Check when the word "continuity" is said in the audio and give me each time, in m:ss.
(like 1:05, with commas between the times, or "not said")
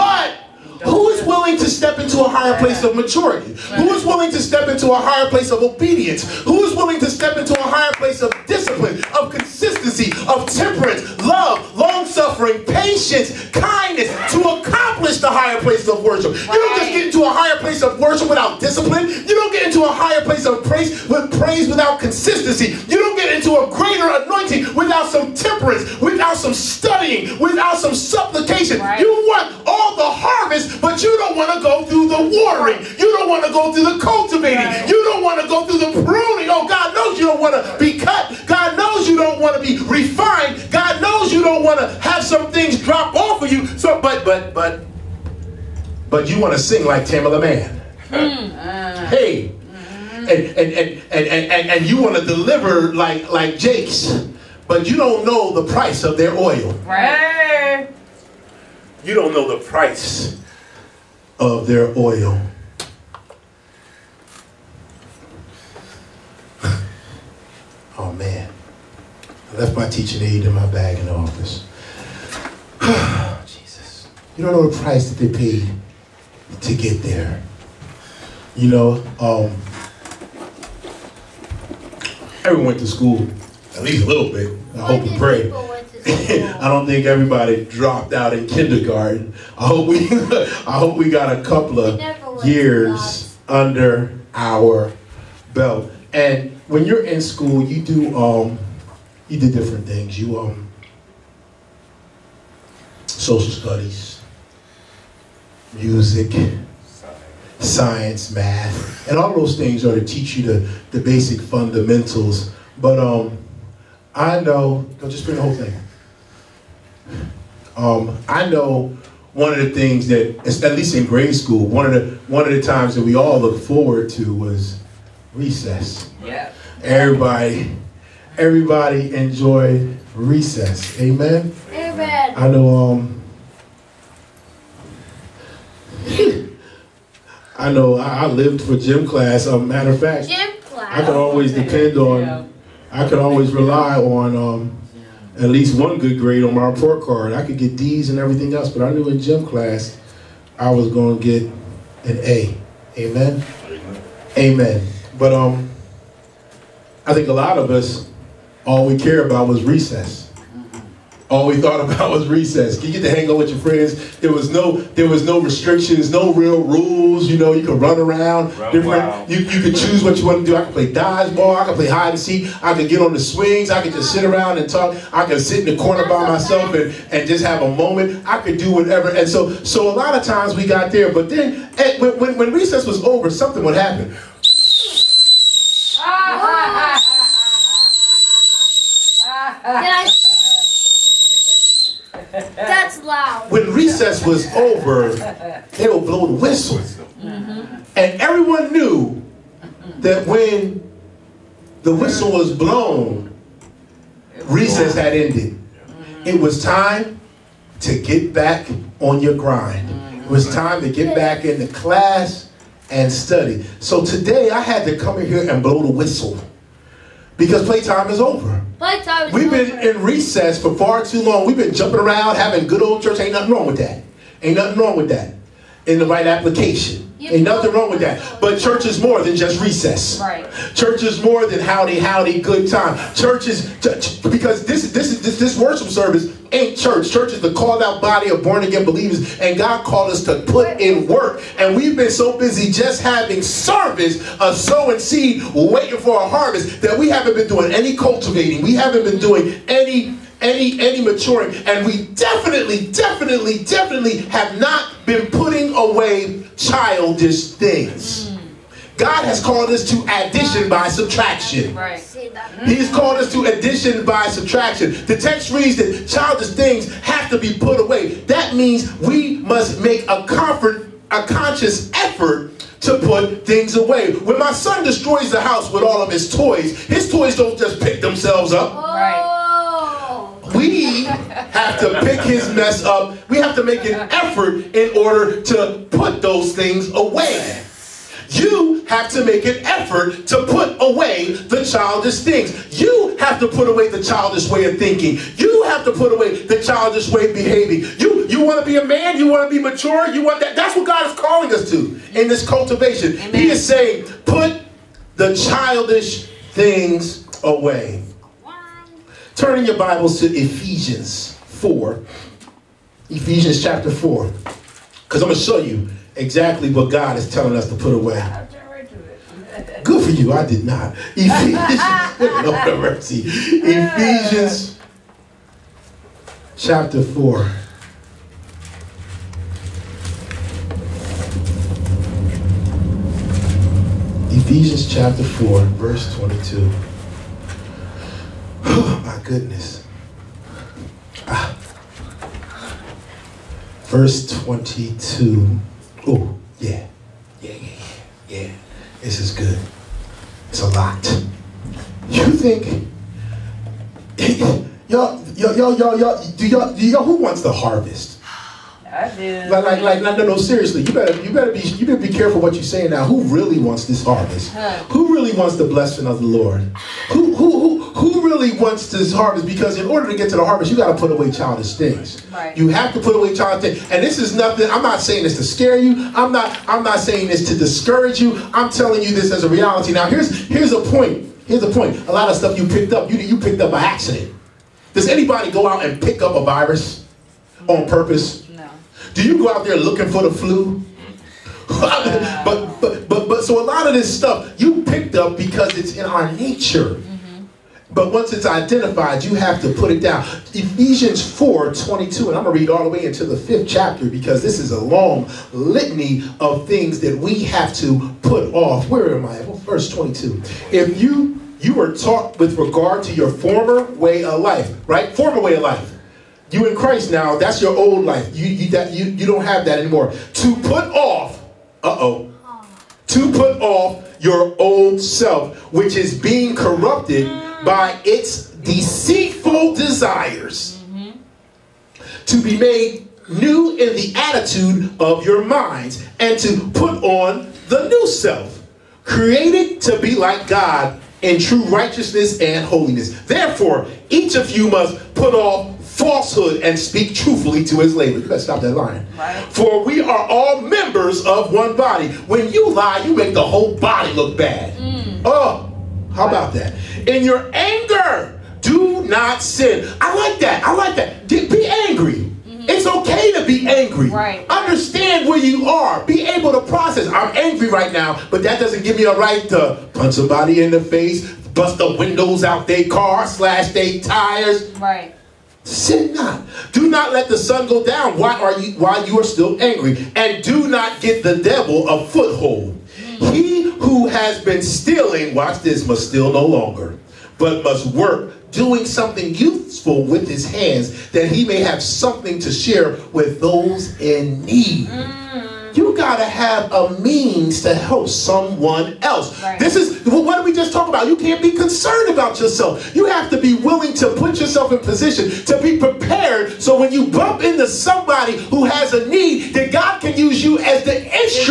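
not said.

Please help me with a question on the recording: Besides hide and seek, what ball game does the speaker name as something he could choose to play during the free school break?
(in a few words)
dodgeball.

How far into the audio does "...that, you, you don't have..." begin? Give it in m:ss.
6:58.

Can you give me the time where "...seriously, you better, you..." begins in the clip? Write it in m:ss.
6:00.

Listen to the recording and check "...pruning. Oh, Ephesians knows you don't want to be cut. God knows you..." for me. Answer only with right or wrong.
wrong.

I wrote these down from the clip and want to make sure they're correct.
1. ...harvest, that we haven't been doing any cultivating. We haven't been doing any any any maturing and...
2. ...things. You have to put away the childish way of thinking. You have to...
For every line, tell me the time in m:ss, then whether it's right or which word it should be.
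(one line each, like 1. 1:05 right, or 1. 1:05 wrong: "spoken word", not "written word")
1. 4:06 right
2. 4:52 right.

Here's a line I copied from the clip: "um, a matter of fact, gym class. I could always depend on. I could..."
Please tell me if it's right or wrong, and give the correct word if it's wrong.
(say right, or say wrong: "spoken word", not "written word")
right.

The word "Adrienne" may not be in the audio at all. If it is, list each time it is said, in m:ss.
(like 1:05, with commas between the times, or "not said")
not said.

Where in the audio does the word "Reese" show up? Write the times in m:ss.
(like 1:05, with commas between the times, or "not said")
not said.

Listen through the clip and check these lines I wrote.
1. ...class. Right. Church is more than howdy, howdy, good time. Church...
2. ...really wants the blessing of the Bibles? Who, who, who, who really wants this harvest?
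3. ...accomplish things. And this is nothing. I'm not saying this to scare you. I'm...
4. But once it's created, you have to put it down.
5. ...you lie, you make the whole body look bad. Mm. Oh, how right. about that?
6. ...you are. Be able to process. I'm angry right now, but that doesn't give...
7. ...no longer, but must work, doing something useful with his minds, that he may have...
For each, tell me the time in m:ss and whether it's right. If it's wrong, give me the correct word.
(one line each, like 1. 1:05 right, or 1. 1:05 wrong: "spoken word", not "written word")
1. 3:49 wrong: "recess", not "class"
2. 6:05 wrong: "Lord", not "Bibles"
3. 6:13 wrong: "childish", not "accomplish"
4. 6:37 wrong: "identified", not "created"
5. 7:32 right
6. 7:45 right
7. 8:06 wrong: "hands", not "minds".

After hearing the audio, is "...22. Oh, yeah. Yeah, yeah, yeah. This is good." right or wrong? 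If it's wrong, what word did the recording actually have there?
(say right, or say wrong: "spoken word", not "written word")
right.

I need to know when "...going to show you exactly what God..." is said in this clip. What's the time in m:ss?
5:15.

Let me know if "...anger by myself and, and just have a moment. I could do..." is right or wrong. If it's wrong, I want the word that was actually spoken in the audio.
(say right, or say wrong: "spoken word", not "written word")
wrong: "corner", not "anger".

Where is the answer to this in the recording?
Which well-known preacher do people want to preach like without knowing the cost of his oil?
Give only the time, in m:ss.
0:53.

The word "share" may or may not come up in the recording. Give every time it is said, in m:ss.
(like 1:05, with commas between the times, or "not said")
8:12.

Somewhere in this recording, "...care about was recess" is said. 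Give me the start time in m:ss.
2:38.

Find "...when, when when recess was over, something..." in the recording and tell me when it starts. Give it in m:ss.
3:02.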